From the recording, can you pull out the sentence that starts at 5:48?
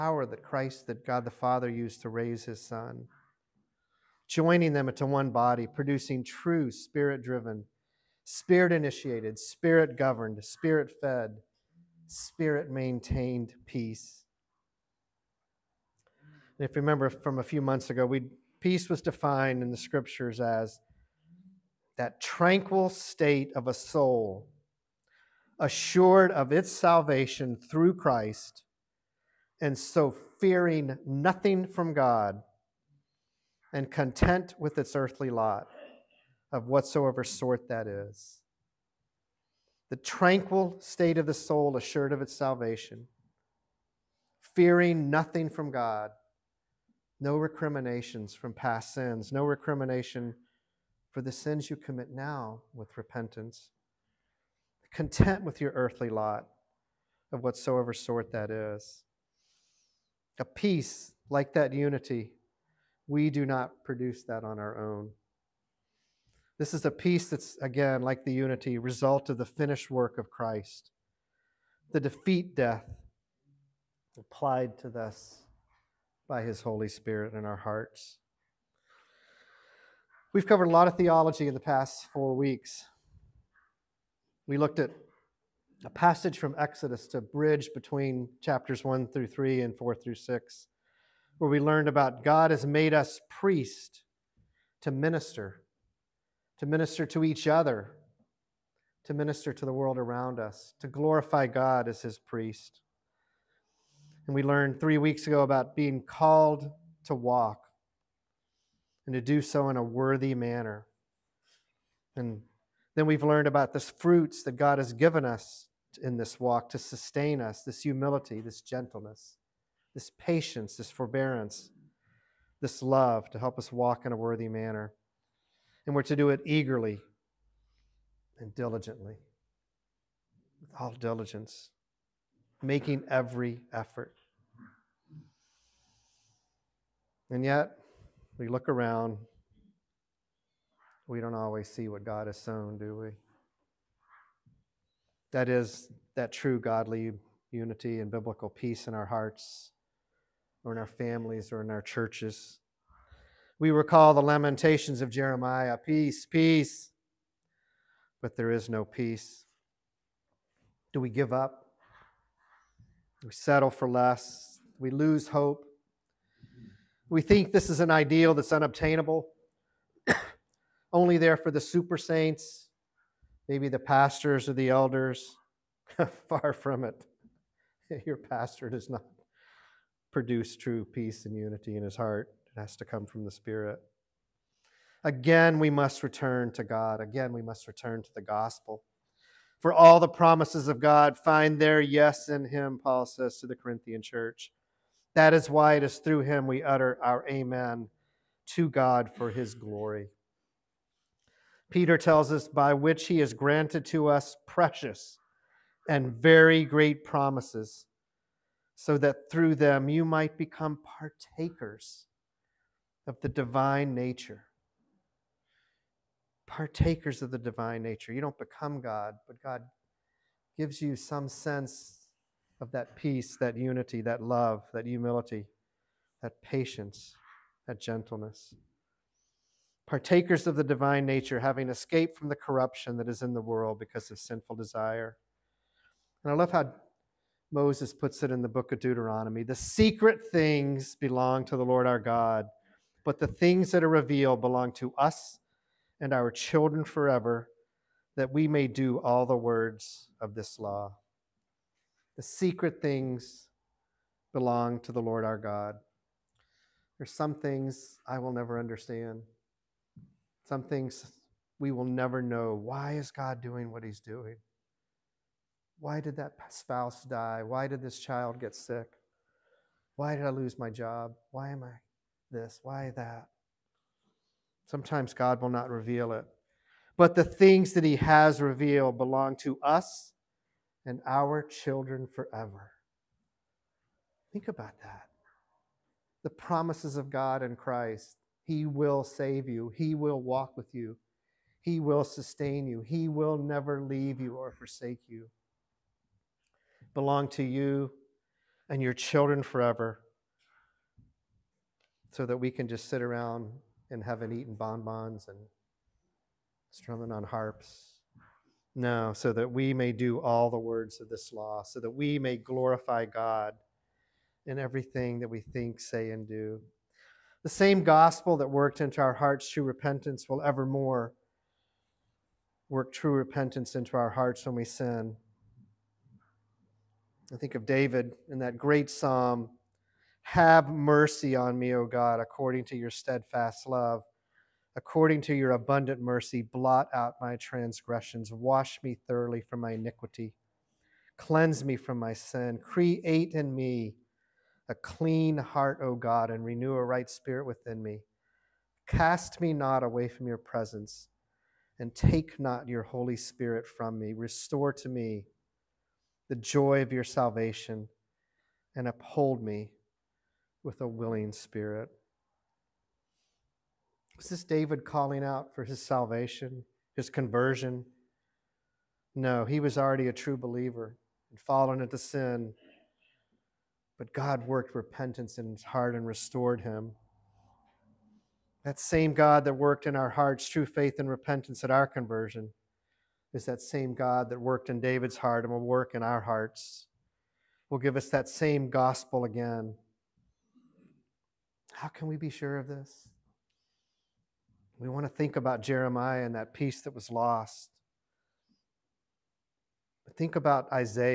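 Cast me not away from your presence, and take not your Holy Spirit from me.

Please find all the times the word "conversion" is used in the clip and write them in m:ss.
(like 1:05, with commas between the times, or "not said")
6:07, 6:21.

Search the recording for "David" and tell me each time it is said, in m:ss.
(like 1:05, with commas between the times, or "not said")
5:27, 6:04, 6:24.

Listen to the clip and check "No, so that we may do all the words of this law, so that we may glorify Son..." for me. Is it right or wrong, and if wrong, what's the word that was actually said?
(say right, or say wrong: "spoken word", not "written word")
wrong: "God", not "Son".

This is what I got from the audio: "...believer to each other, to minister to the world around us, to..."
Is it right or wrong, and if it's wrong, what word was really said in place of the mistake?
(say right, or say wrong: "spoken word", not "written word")
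wrong: "minister", not "believer".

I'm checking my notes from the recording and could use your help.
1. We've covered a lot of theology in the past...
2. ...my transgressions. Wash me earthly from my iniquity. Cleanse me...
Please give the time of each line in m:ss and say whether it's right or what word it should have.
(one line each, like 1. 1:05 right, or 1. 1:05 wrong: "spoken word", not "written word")
1. 1:20 right
2. 5:37 wrong: "thoroughly", not "earthly".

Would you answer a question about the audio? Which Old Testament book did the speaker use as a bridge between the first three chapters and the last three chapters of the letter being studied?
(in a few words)
Exodus.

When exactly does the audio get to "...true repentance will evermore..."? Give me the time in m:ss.
5:19.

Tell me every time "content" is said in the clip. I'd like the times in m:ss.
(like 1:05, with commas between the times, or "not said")
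0:33, 0:54.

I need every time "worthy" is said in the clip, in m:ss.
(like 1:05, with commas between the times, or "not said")
1:49, 2:04.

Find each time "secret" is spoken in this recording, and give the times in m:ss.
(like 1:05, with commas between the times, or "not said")
3:59, 4:12.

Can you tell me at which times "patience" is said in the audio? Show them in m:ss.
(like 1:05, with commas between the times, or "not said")
2:00, 3:46.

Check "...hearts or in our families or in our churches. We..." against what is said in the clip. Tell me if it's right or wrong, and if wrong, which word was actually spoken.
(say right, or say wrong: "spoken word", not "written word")
right.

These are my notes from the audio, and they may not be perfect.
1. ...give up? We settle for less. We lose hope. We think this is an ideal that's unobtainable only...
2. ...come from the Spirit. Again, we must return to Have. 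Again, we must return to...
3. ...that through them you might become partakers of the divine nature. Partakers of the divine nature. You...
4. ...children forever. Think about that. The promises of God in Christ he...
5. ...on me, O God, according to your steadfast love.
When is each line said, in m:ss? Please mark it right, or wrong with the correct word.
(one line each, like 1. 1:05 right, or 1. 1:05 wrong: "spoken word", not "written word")
1. 2:41 right
2. 3:02 wrong: "God", not "Have"
3. 3:28 right
4. 4:41 right
5. 5:31 right.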